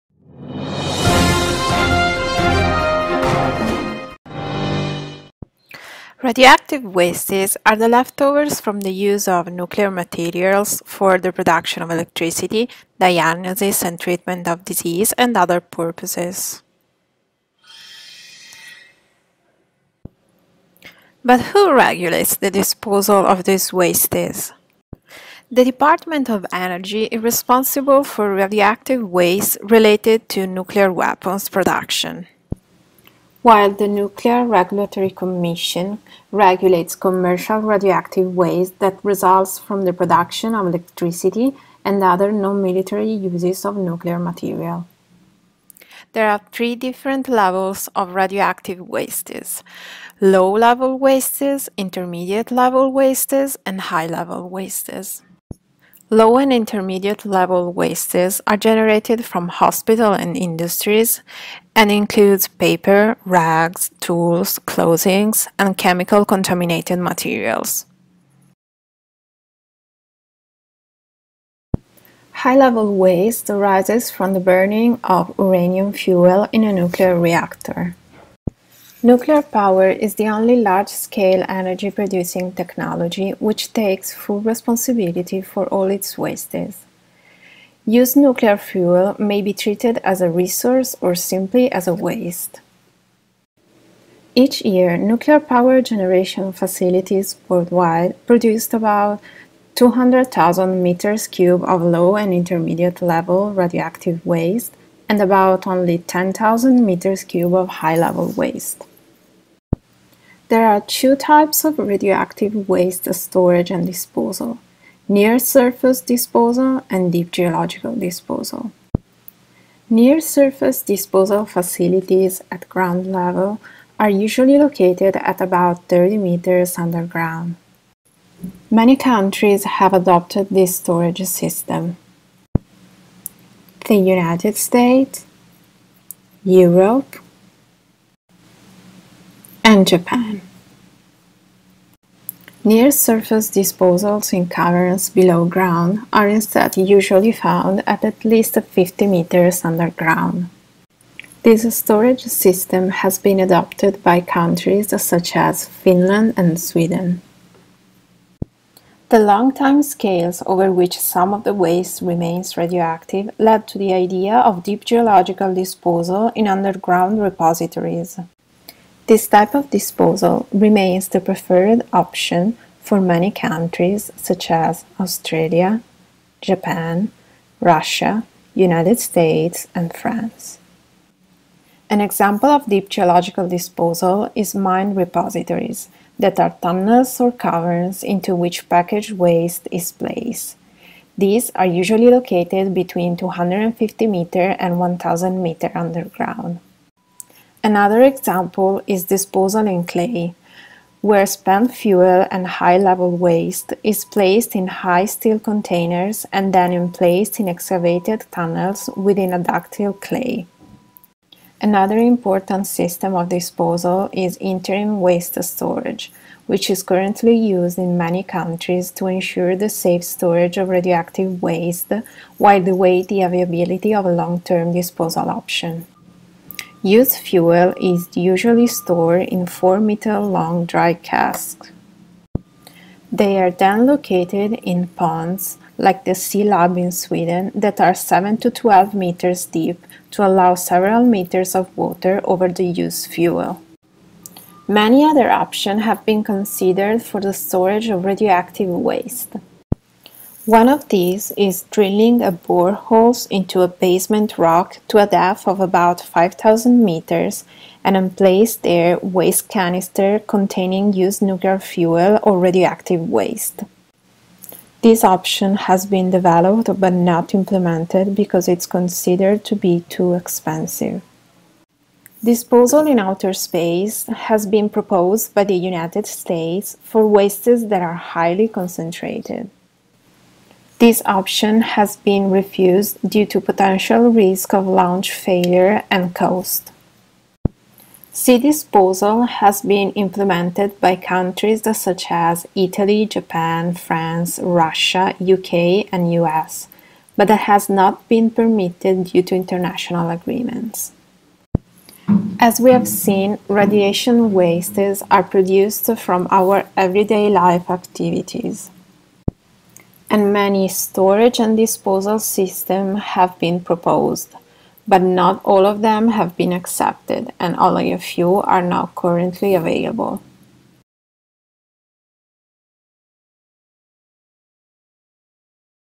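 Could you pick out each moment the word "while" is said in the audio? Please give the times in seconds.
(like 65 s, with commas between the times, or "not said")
33 s, 222 s.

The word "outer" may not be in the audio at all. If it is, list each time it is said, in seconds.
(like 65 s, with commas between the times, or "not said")
272 s.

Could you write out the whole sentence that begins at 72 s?
High-level waste arises from the burning of uranium fuel in a nuclear reactor.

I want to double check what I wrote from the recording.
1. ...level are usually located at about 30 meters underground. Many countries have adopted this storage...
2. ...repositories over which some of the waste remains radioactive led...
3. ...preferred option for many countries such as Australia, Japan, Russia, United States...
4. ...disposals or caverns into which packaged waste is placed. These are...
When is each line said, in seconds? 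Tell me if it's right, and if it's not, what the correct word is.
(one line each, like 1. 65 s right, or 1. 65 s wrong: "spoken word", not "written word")
1. 123 s right
2. 159 s wrong: "scales", not "repositories"
3. 171 s right
4. 186 s wrong: "tunnels", not "disposals".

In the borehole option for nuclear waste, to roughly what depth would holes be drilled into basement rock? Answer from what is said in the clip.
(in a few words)
5,000 meters.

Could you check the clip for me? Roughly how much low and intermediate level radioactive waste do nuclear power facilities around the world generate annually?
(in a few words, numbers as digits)
200,000 cubic meters.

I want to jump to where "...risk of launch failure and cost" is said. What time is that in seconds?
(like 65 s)
284 s.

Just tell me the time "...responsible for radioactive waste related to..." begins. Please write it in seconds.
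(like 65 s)
27 s.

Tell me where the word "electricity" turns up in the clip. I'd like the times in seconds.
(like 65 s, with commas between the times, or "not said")
11 s, 40 s.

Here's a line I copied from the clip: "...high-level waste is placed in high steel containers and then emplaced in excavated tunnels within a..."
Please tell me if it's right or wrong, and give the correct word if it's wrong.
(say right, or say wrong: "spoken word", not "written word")
right.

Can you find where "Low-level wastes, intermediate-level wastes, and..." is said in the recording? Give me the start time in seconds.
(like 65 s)
50 s.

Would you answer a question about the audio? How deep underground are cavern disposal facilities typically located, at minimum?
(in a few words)
50 meters.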